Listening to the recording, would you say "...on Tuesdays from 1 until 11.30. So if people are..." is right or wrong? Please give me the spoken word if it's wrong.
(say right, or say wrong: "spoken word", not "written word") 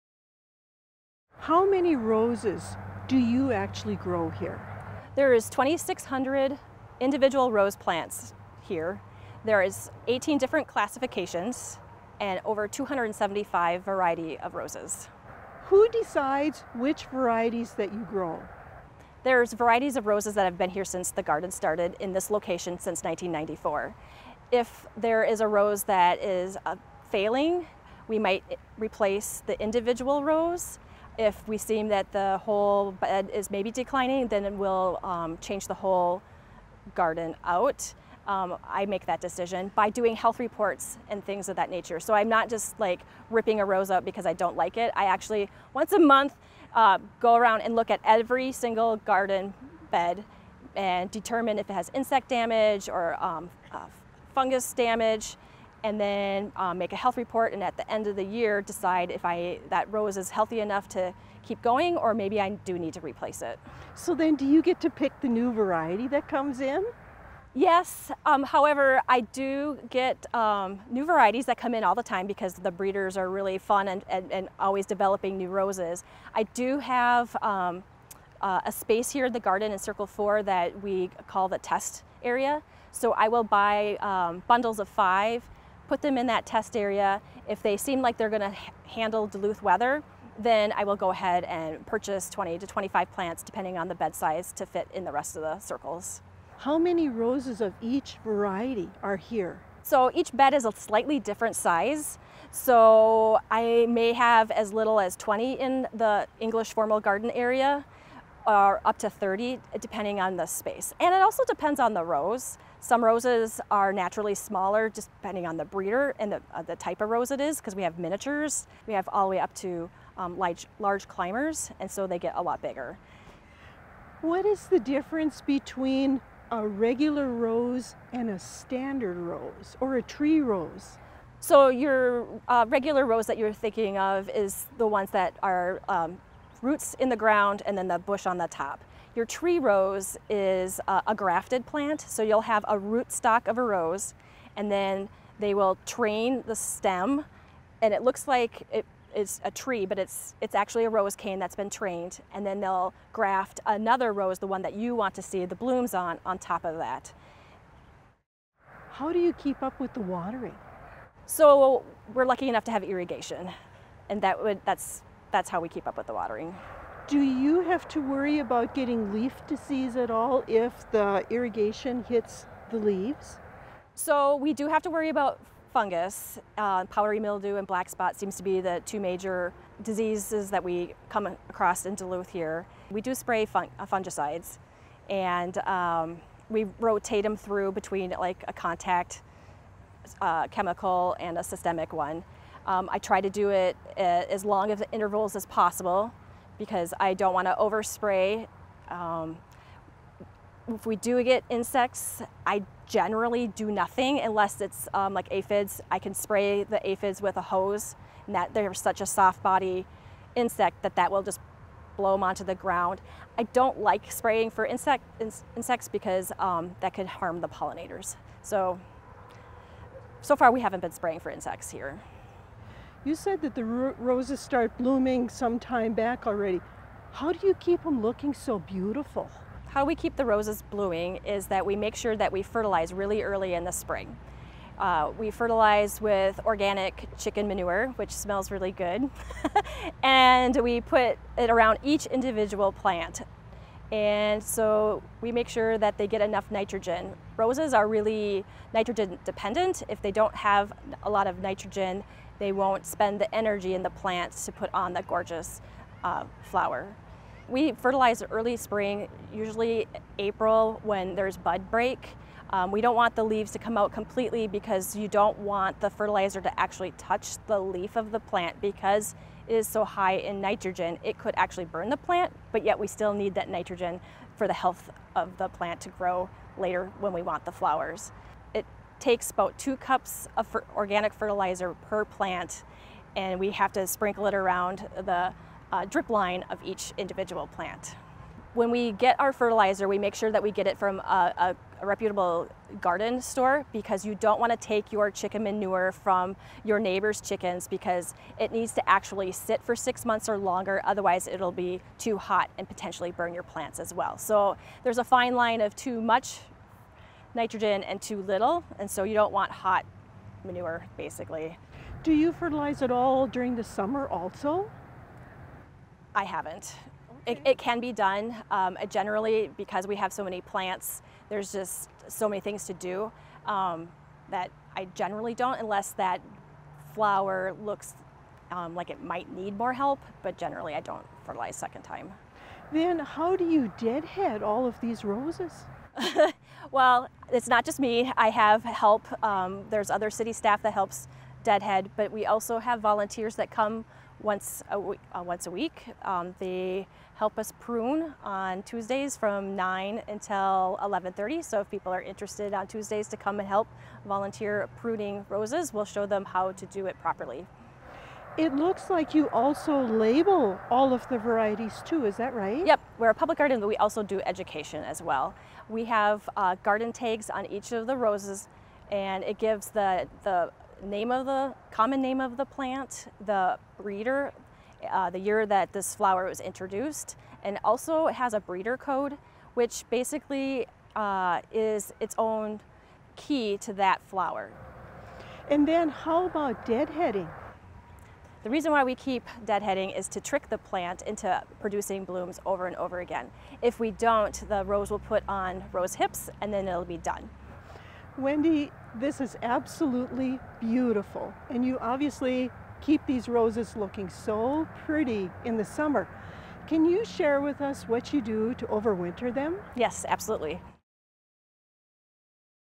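wrong: "9", not "1".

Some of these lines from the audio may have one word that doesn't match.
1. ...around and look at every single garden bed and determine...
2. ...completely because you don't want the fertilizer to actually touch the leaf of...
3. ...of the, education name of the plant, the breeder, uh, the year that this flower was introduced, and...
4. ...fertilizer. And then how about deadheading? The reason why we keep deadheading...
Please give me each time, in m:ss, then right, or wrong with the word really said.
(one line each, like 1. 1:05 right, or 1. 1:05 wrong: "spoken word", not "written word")
1. 0:47 right
2. 4:23 right
3. 6:11 wrong: "common", not "education"
4. 6:24 wrong: "flower", not "fertilizer".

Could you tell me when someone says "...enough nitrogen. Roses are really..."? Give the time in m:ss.
4:06.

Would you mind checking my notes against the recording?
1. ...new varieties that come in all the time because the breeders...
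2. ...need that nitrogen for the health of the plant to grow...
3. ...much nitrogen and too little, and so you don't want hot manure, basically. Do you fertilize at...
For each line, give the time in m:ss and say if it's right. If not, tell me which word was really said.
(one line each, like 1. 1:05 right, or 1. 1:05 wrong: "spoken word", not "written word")
1. 1:10 right
2. 4:33 right
3. 5:06 right.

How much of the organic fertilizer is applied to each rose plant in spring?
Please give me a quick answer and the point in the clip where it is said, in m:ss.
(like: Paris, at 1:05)
2 cups, at 4:39.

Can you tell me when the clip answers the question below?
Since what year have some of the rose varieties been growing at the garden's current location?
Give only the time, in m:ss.
0:23.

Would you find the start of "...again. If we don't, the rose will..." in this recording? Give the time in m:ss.
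6:32.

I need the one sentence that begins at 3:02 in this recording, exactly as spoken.
We do spray uh, fungicides and um, we rotate them through between like a contact uh, chemical and a systemic one.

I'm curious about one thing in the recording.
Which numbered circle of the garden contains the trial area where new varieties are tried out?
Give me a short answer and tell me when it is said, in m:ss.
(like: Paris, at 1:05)
Circle 4, at 1:19.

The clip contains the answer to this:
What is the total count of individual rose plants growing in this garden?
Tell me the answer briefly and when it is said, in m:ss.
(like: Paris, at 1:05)
2,600, at 0:05.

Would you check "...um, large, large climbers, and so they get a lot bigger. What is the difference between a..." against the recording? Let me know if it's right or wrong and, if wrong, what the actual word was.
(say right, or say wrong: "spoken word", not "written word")
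right.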